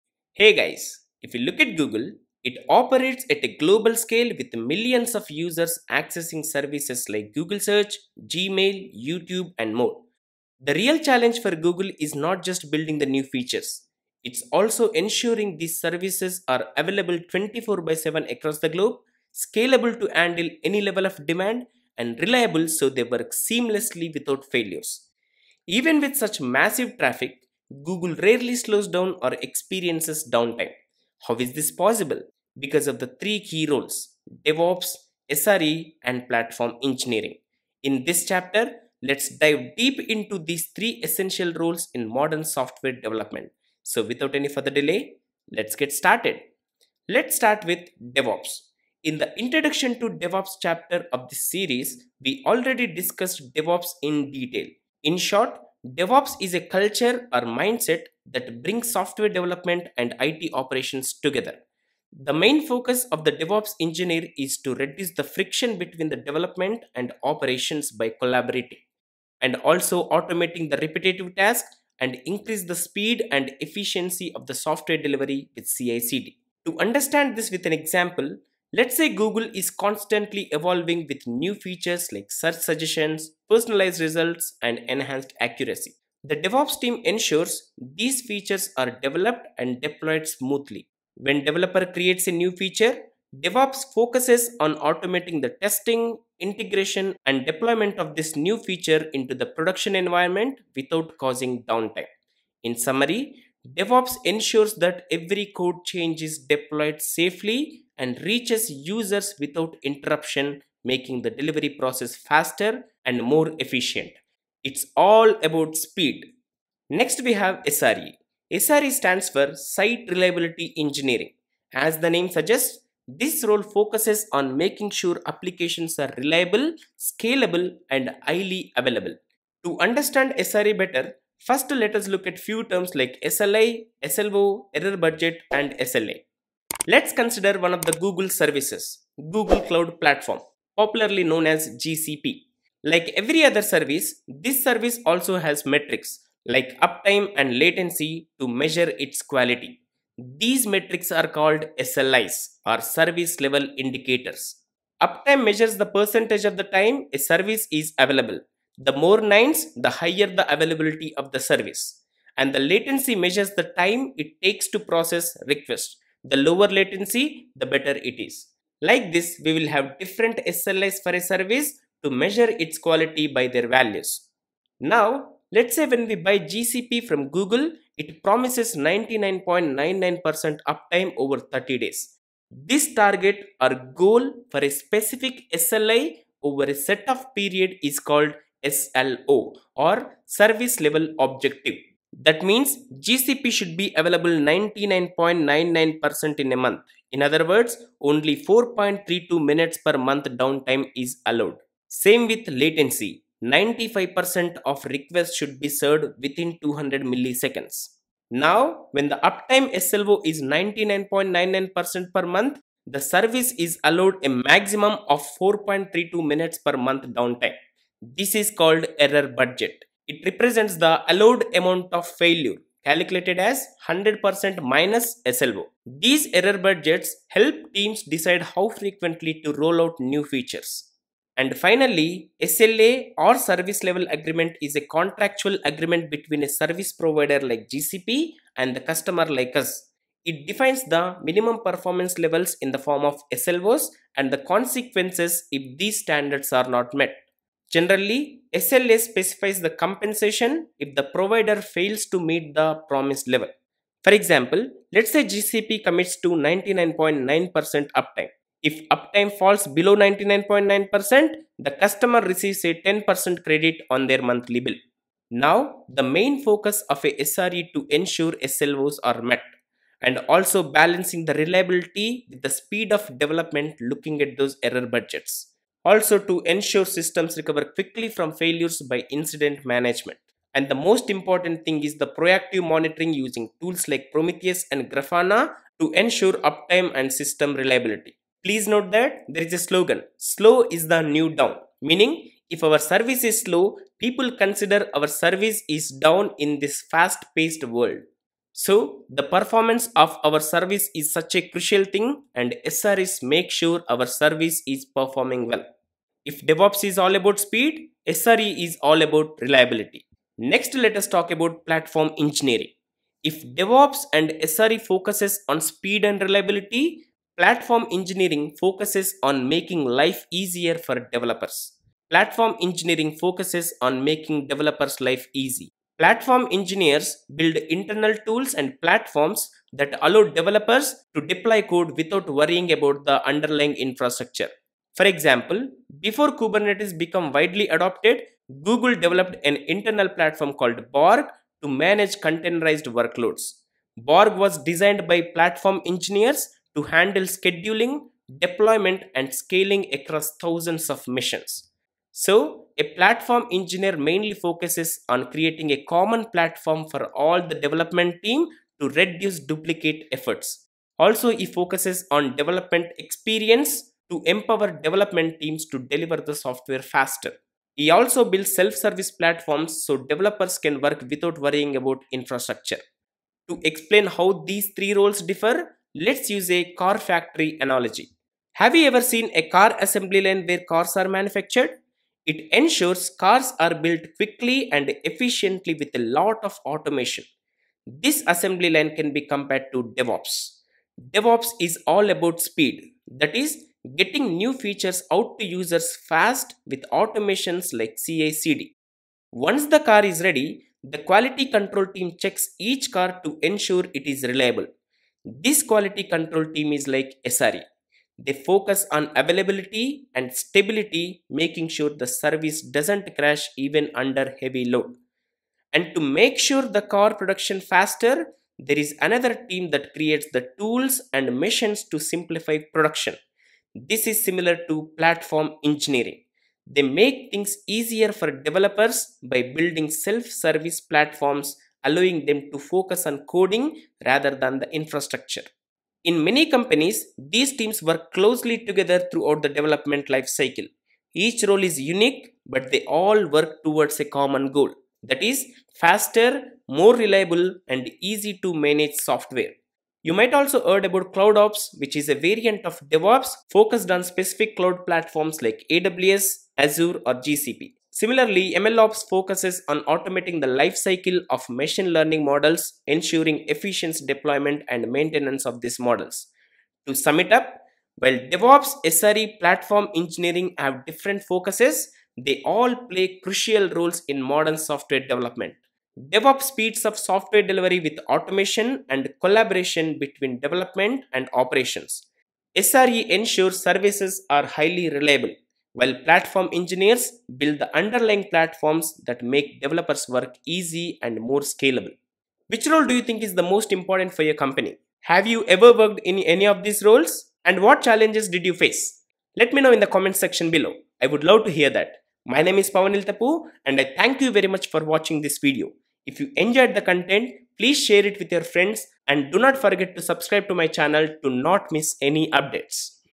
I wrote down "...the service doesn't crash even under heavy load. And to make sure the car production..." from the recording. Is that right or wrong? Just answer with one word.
right.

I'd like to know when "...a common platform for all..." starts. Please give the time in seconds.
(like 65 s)
355 s.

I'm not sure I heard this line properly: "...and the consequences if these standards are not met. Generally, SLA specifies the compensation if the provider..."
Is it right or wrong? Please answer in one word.
right.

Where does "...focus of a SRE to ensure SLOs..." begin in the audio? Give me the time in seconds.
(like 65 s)
266 s.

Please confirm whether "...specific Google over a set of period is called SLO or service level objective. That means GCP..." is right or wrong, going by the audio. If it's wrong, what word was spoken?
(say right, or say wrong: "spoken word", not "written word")
wrong: "SLI", not "Google".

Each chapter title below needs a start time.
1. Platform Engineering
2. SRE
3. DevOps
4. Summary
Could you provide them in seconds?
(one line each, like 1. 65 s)
1. 311 s
2. 117 s
3. 47 s
4. 374 s.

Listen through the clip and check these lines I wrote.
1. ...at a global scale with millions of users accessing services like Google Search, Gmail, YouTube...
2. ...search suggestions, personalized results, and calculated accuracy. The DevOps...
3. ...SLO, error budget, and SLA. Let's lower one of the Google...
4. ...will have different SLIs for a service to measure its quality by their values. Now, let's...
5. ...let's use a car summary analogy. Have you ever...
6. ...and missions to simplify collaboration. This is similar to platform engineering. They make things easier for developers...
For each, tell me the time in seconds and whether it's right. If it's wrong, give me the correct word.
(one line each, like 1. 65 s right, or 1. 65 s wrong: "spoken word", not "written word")
1. 3 s right
2. 82 s wrong: "enhanced", not "calculated"
3. 134 s wrong: "consider", not "lower"
4. 169 s right
5. 375 s wrong: "factory", not "summary"
6. 421 s wrong: "production", not "collaboration".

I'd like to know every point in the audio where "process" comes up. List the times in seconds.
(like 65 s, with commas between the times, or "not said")
111 s, 164 s.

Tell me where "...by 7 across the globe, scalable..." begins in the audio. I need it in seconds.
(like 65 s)
17 s.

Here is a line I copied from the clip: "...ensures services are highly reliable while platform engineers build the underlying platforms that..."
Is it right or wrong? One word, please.
right.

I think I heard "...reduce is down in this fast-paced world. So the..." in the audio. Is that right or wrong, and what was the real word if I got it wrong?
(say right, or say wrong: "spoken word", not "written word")
wrong: "service", not "reduce".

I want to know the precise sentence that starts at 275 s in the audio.
Also to ensure systems recover quickly from failures by incident management.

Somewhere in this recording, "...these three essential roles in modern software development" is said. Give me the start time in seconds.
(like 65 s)
40 s.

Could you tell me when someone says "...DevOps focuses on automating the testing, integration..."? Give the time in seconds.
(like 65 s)
93 s.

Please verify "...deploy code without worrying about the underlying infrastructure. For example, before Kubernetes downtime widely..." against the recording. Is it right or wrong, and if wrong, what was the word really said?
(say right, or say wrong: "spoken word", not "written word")
wrong: "became", not "downtime".